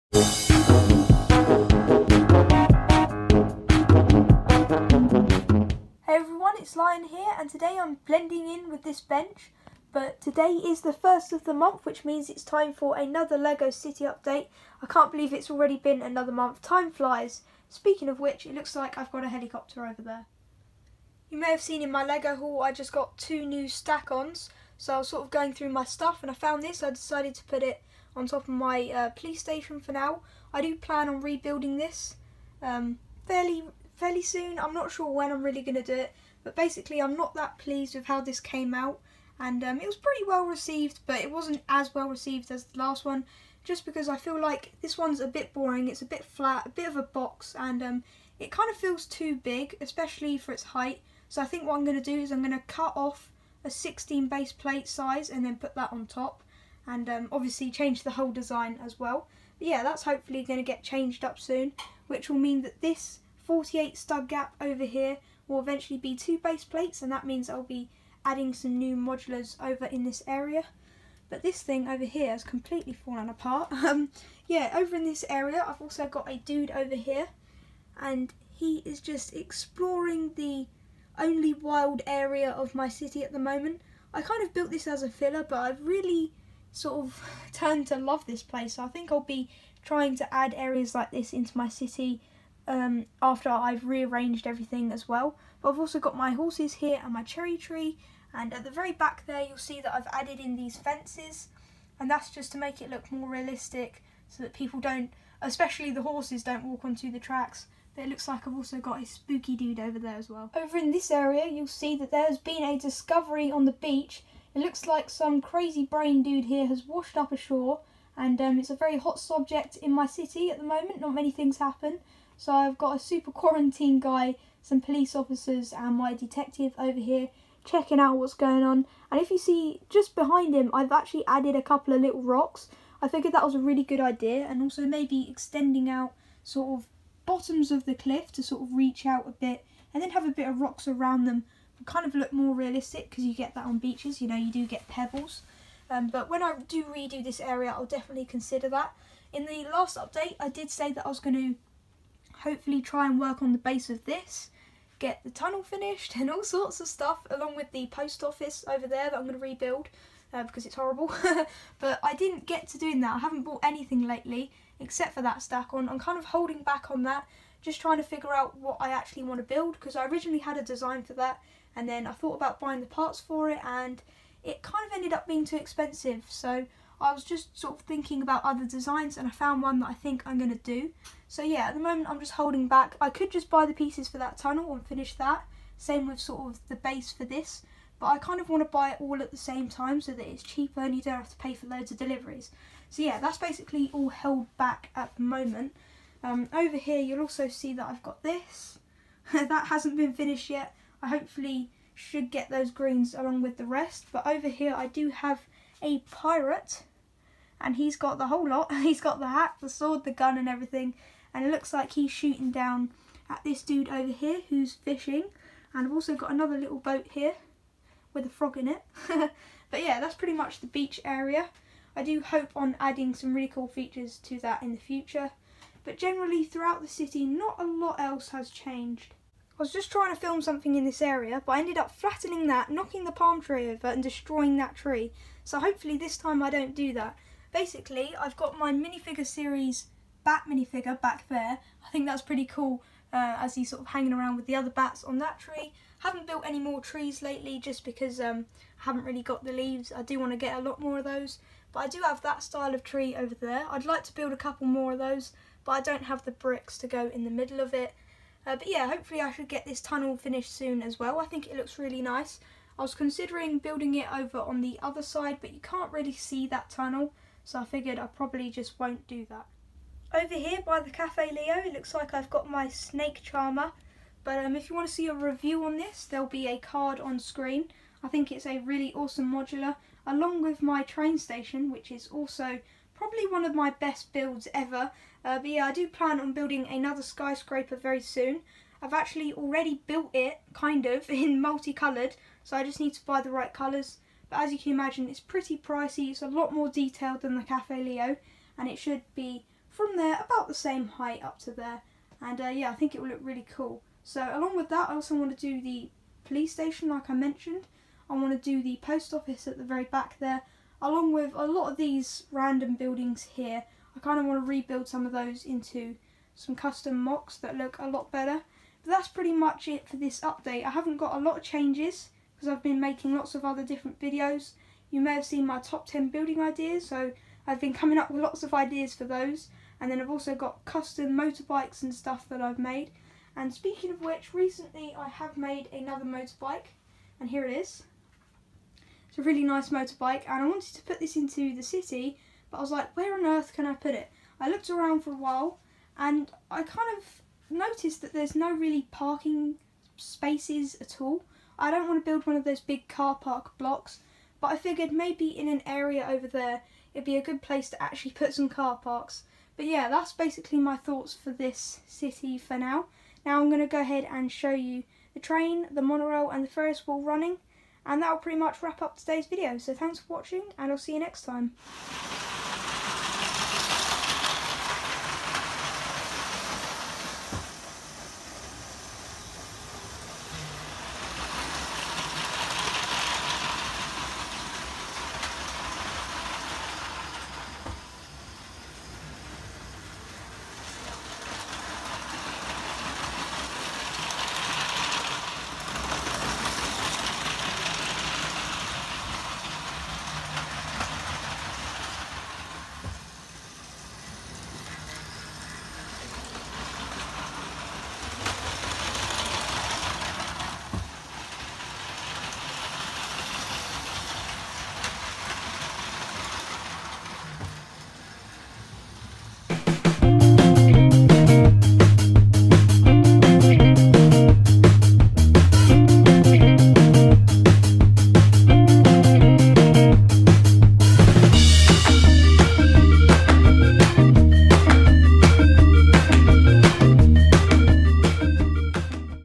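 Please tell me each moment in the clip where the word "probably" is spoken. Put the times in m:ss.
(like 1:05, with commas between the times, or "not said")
4:28, 4:42.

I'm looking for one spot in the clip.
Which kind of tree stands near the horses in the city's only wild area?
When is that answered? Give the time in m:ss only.
1:37.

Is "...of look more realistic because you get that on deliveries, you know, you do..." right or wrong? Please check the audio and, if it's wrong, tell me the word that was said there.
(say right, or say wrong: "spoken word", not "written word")
wrong: "beaches", not "deliveries".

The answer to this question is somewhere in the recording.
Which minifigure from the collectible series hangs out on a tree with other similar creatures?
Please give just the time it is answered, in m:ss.
4:00.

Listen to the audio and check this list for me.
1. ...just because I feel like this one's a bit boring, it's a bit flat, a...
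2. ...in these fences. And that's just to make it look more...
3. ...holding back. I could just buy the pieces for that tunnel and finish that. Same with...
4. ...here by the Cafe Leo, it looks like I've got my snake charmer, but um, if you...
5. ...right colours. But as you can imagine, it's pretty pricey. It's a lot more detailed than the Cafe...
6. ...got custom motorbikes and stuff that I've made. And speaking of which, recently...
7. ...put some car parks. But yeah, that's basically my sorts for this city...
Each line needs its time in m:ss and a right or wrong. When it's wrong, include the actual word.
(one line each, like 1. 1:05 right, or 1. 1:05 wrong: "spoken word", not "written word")
1. 0:43 right
2. 1:40 right
3. 3:02 right
4. 4:30 right
5. 4:53 right
6. 5:30 right
7. 5:58 wrong: "thoughts", not "sorts".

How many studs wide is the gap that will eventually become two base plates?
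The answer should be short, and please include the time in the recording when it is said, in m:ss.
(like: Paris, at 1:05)
48, at 1:03.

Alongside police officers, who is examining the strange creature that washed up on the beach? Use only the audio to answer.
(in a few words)
detective.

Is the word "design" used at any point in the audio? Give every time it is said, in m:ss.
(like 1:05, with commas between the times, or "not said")
0:58, 2:50, 2:58.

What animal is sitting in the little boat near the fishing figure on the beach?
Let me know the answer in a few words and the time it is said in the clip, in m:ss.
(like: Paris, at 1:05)
frog, at 3:38.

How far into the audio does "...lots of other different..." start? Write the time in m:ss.
5:23.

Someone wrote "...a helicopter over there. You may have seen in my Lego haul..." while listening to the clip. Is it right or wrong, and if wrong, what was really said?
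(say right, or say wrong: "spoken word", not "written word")
right.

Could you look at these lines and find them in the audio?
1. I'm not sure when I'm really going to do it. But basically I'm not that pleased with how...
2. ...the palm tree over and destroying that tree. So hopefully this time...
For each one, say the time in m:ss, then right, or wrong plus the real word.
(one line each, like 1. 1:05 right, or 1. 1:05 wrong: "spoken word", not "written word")
1. 0:34 right
2. 3:53 right.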